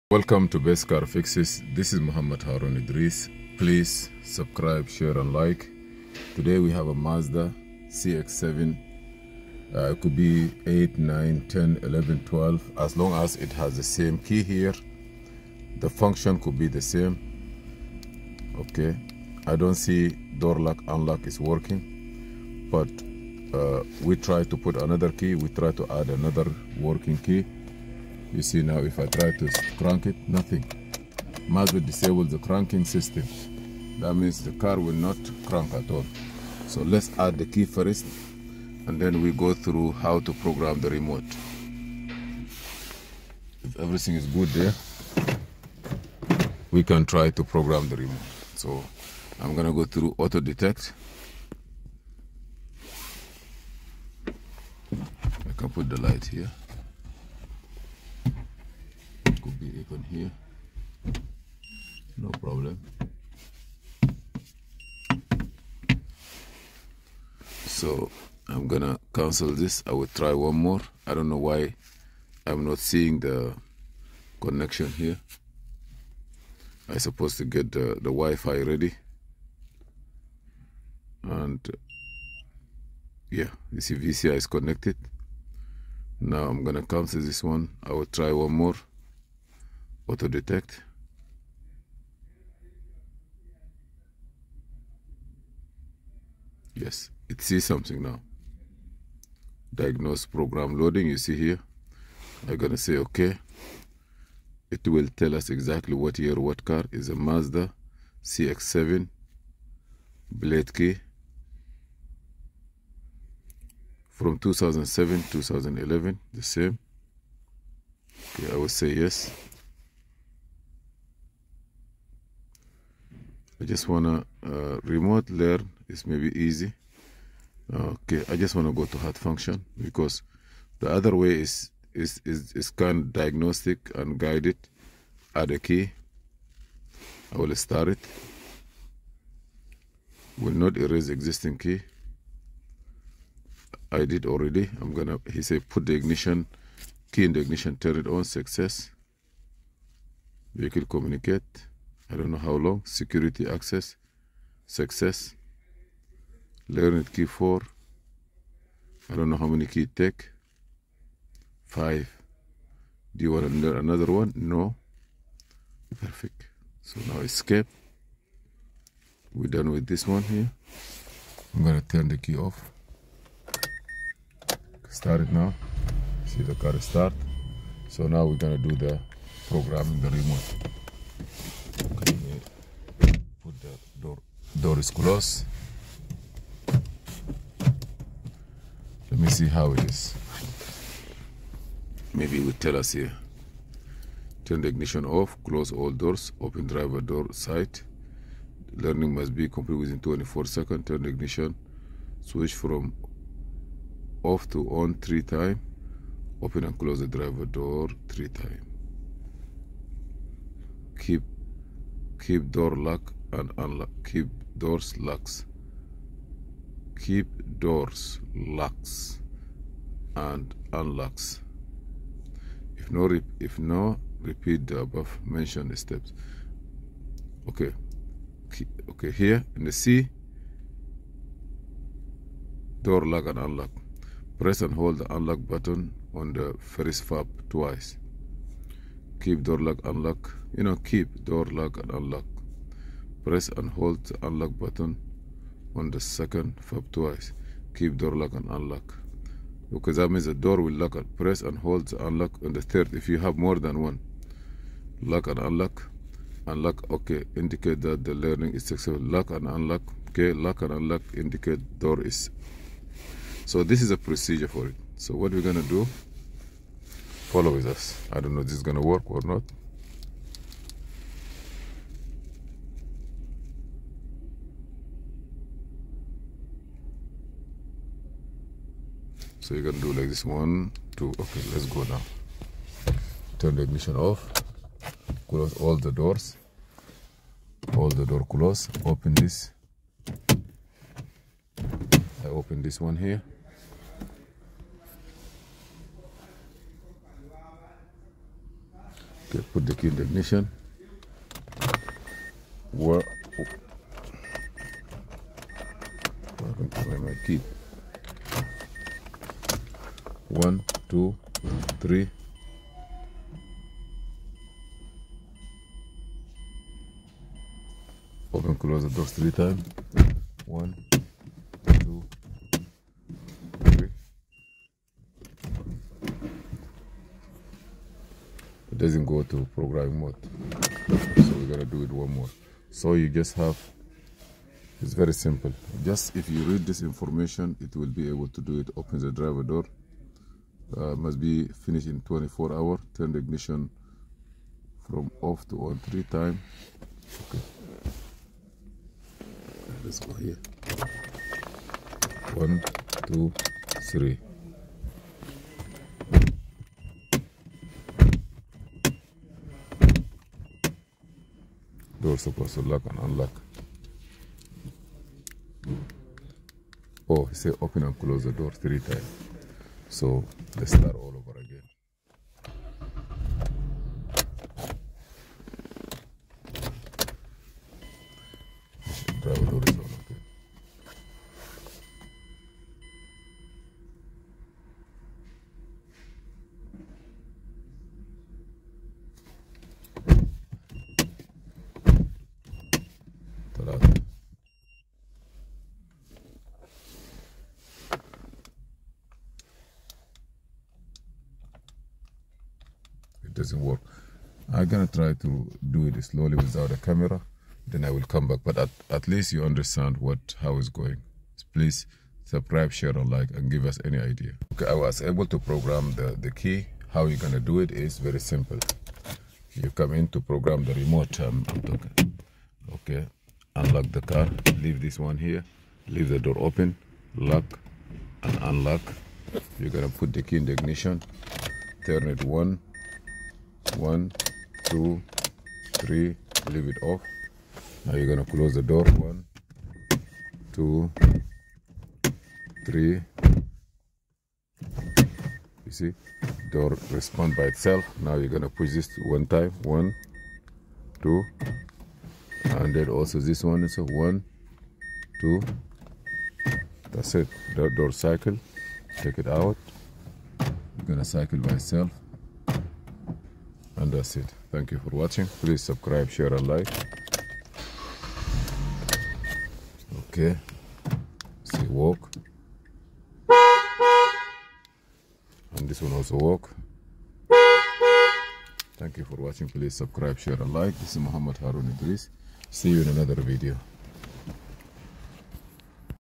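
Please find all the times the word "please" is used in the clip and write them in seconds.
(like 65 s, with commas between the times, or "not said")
3 s, 411 s, 465 s, 479 s.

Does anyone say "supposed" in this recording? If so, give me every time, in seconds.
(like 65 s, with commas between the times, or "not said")
76 s, 362 s.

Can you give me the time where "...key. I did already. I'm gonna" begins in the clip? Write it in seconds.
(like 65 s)
141 s.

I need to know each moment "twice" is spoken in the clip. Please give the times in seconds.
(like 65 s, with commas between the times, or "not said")
237 s, 246 s.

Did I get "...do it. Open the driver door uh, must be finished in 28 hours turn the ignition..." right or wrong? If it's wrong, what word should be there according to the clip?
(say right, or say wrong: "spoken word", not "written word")
wrong: "24", not "28".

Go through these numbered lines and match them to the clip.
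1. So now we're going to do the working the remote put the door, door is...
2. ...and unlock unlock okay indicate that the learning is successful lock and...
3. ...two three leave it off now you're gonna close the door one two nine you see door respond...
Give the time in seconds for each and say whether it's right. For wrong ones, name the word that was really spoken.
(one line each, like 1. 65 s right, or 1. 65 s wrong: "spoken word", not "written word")
1. 177 s wrong: "programming", not "working"
2. 255 s right
3. 434 s wrong: "three", not "nine".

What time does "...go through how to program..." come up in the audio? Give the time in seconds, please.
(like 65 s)
39 s.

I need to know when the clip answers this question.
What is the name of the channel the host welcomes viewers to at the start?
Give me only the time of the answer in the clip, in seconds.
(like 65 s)
0 s.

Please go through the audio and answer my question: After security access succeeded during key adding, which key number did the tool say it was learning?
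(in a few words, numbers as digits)
4.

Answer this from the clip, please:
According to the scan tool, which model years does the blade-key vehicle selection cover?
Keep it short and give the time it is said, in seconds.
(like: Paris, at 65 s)
2007-2011, at 114 s.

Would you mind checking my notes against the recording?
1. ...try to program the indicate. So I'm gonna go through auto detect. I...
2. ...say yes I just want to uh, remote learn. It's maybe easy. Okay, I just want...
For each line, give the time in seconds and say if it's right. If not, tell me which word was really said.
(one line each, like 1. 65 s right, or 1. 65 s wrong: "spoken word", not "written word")
1. 47 s wrong: "remote", not "indicate"
2. 118 s right.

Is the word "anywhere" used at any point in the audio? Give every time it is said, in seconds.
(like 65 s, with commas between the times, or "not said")
not said.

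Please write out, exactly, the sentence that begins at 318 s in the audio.
Open, close the doors three times.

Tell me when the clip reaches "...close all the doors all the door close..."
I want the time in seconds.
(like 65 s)
285 s.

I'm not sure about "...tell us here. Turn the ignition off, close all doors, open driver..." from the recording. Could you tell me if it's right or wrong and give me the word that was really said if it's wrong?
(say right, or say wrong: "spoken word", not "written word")
right.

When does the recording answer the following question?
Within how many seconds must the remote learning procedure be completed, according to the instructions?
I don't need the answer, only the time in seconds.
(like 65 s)
199 s.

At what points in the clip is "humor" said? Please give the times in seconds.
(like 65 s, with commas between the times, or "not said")
not said.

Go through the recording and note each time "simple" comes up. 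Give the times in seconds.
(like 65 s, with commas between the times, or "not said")
335 s, 418 s.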